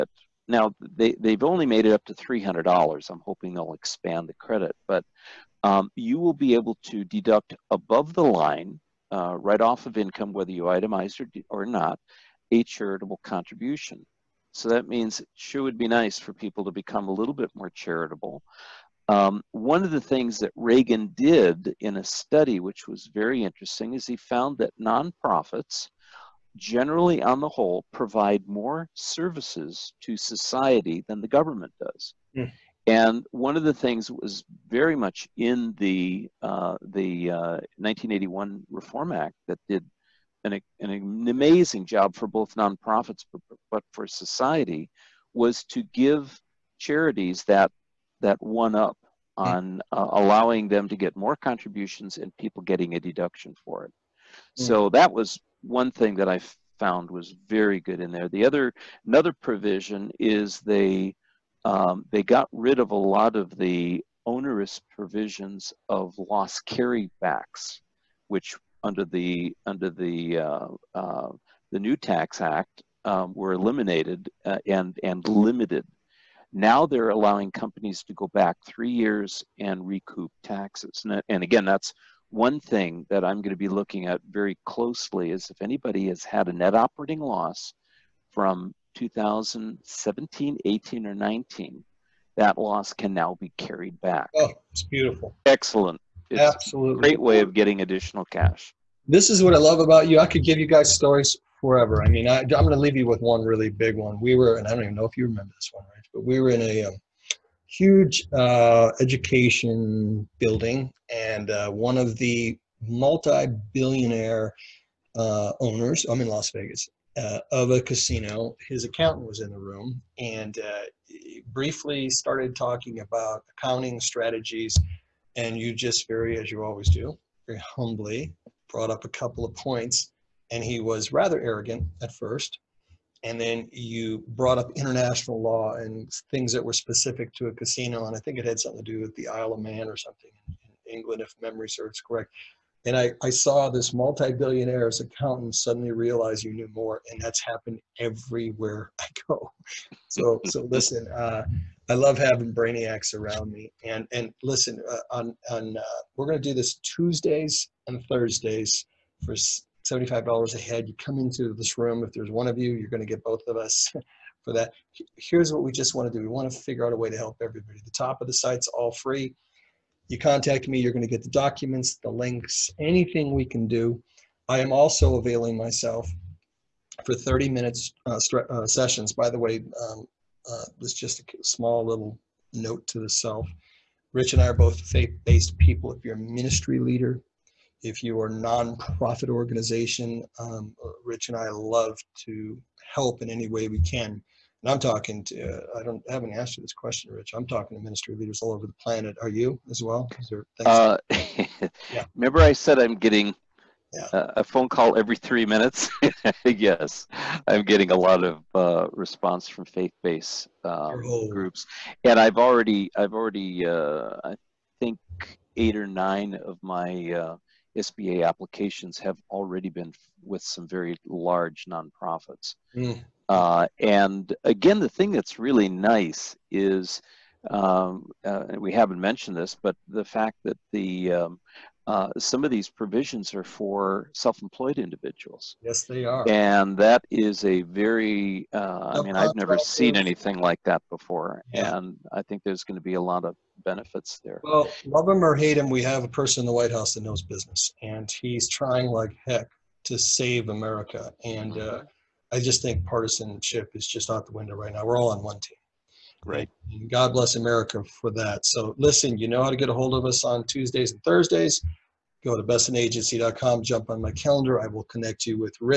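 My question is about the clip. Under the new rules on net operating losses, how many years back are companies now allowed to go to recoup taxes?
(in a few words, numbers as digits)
3 years.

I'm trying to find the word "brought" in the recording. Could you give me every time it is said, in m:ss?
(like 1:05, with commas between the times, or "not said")
2:08, 2:14.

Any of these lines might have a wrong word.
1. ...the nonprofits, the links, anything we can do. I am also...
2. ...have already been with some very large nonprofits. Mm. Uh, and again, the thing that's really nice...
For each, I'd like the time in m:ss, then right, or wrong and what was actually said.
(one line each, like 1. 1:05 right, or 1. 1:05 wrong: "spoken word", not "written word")
1. 2:51 wrong: "documents", not "nonprofits"
2. 3:38 right.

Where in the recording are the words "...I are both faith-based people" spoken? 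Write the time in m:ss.
3:04.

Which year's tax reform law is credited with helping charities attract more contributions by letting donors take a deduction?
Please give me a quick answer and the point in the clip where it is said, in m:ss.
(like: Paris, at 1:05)
1981, at 0:37.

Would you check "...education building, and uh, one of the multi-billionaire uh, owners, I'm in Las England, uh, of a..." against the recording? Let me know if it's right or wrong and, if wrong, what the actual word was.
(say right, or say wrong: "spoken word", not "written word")
wrong: "Vegas", not "England".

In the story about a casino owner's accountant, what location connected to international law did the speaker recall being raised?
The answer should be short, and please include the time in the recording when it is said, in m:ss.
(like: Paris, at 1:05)
Isle of Man, at 2:19.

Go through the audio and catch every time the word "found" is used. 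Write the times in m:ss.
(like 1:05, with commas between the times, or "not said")
0:24, 0:56.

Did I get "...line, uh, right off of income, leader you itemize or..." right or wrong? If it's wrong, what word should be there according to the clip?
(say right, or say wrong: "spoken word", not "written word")
wrong: "whether", not "leader".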